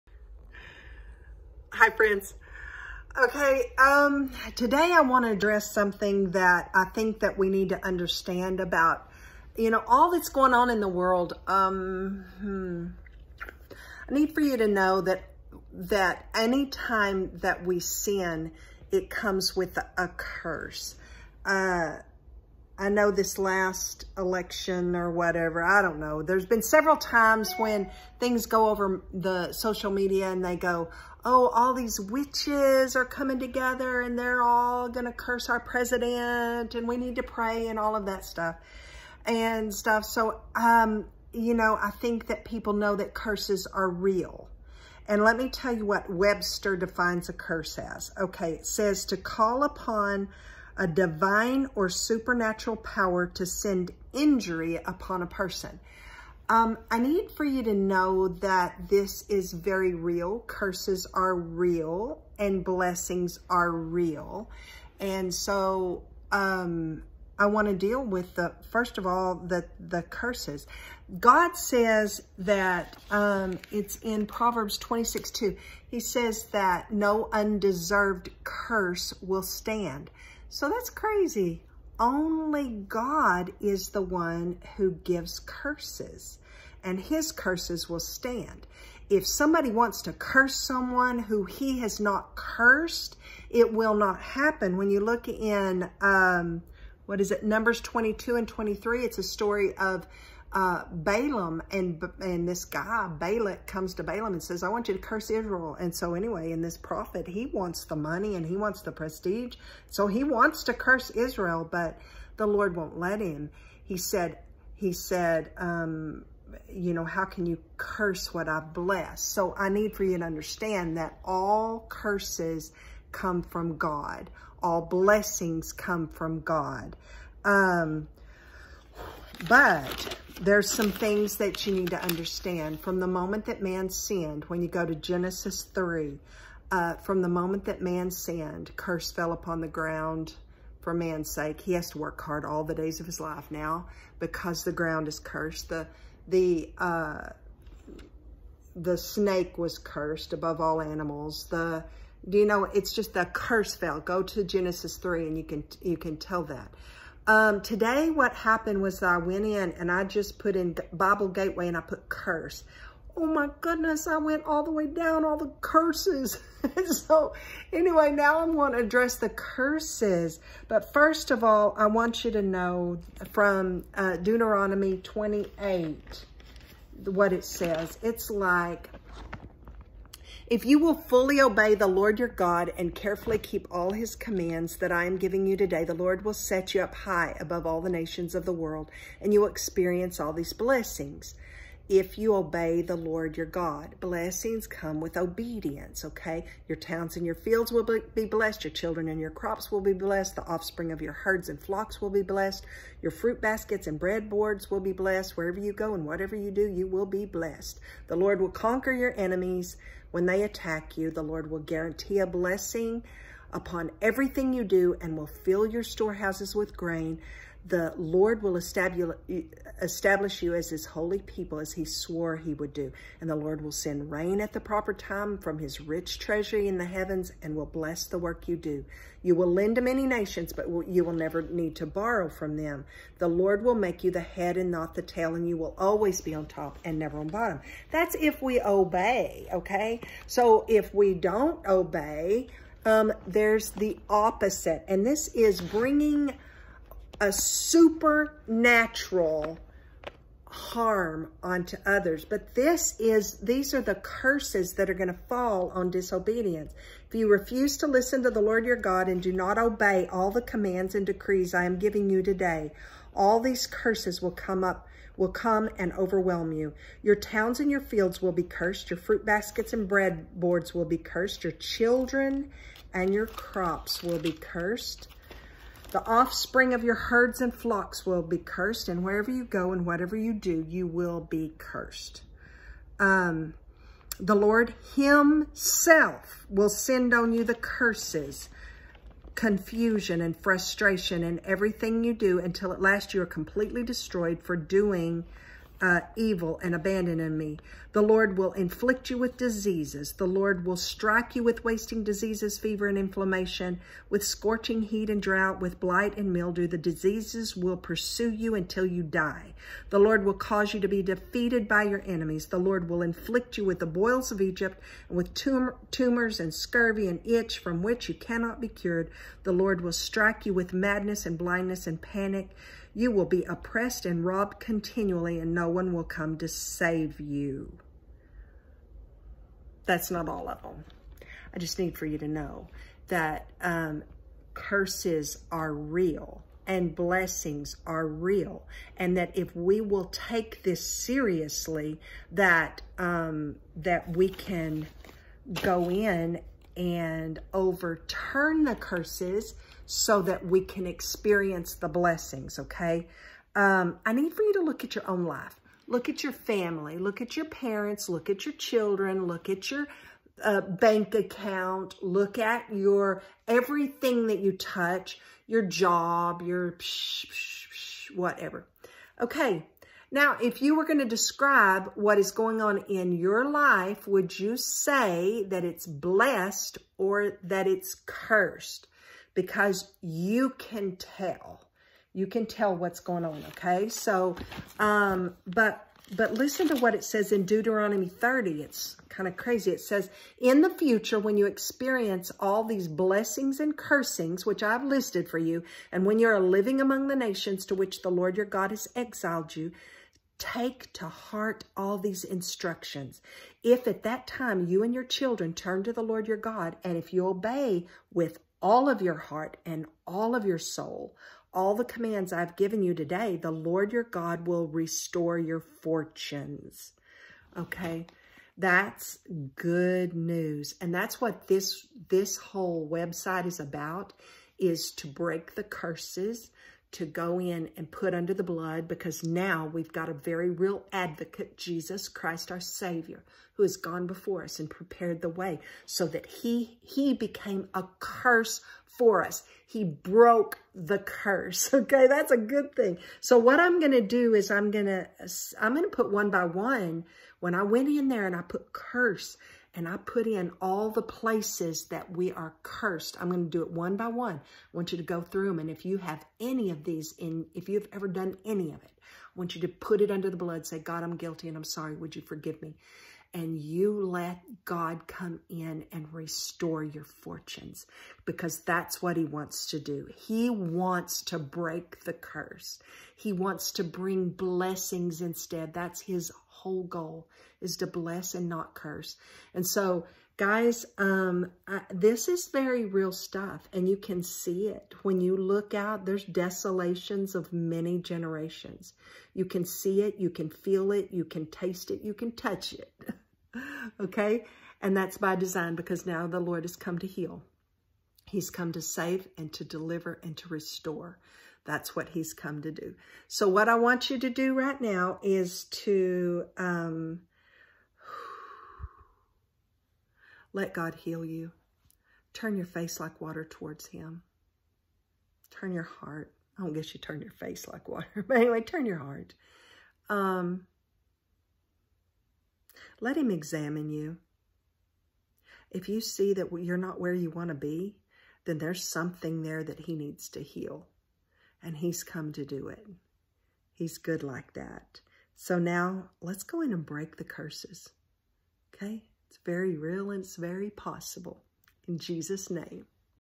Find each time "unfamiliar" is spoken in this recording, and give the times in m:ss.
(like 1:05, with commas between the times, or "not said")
not said.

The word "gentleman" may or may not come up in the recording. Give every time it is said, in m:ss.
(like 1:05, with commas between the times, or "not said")
not said.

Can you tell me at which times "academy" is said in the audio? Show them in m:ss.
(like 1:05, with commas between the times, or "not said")
not said.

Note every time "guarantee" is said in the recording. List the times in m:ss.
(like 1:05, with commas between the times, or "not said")
3:31.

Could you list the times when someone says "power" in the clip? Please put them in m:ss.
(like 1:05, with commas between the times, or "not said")
0:52.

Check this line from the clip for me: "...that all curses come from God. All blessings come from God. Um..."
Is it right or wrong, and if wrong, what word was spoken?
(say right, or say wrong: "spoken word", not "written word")
right.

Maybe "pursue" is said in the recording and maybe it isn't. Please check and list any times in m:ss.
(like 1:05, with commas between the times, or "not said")
5:07.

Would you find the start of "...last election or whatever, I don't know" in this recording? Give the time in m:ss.
0:23.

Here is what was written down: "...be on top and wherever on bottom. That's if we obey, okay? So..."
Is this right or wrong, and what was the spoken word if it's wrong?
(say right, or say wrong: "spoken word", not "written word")
wrong: "never", not "wherever".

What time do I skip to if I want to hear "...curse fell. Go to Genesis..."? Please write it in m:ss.
2:33.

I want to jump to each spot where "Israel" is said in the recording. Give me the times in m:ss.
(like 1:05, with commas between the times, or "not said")
1:45, 1:51.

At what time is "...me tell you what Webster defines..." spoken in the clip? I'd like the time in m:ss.
0:45.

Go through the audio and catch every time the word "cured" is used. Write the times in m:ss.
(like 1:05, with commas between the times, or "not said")
5:18.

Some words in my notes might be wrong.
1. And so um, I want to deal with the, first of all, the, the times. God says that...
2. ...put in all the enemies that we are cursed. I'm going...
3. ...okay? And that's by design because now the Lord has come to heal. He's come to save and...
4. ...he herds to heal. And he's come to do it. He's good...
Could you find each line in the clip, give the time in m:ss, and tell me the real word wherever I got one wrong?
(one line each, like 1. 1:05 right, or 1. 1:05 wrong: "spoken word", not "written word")
1. 1:04 wrong: "curses", not "times"
2. 7:29 wrong: "places", not "enemies"
3. 8:14 right
4. 8:49 wrong: "needs", not "herds".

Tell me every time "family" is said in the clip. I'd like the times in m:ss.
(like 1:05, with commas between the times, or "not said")
5:56.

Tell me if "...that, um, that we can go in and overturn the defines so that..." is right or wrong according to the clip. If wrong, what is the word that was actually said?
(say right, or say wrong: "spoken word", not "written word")
wrong: "curses", not "defines".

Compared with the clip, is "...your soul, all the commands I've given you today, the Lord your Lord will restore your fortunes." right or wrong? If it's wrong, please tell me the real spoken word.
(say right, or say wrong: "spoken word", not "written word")
wrong: "God", not "Lord".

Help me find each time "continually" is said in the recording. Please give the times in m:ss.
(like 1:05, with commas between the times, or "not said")
5:24.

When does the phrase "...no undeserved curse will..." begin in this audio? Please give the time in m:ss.
1:16.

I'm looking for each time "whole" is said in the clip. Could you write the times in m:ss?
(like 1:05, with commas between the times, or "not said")
7:02, 7:56.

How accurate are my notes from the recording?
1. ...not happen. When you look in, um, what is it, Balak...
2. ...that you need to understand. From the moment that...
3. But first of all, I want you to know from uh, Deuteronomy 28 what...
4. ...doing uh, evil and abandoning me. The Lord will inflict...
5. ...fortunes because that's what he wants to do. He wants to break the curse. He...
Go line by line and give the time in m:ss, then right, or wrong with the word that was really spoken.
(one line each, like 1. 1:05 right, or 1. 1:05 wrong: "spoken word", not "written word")
1. 1:33 wrong: "Numbers", not "Balak"
2. 2:11 right
3. 2:50 right
4. 4:54 right
5. 7:47 right.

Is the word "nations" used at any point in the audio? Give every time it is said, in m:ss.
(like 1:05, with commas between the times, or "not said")
3:07, 3:50, 6:37.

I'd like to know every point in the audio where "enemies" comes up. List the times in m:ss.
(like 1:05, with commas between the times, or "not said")
3:29, 5:12.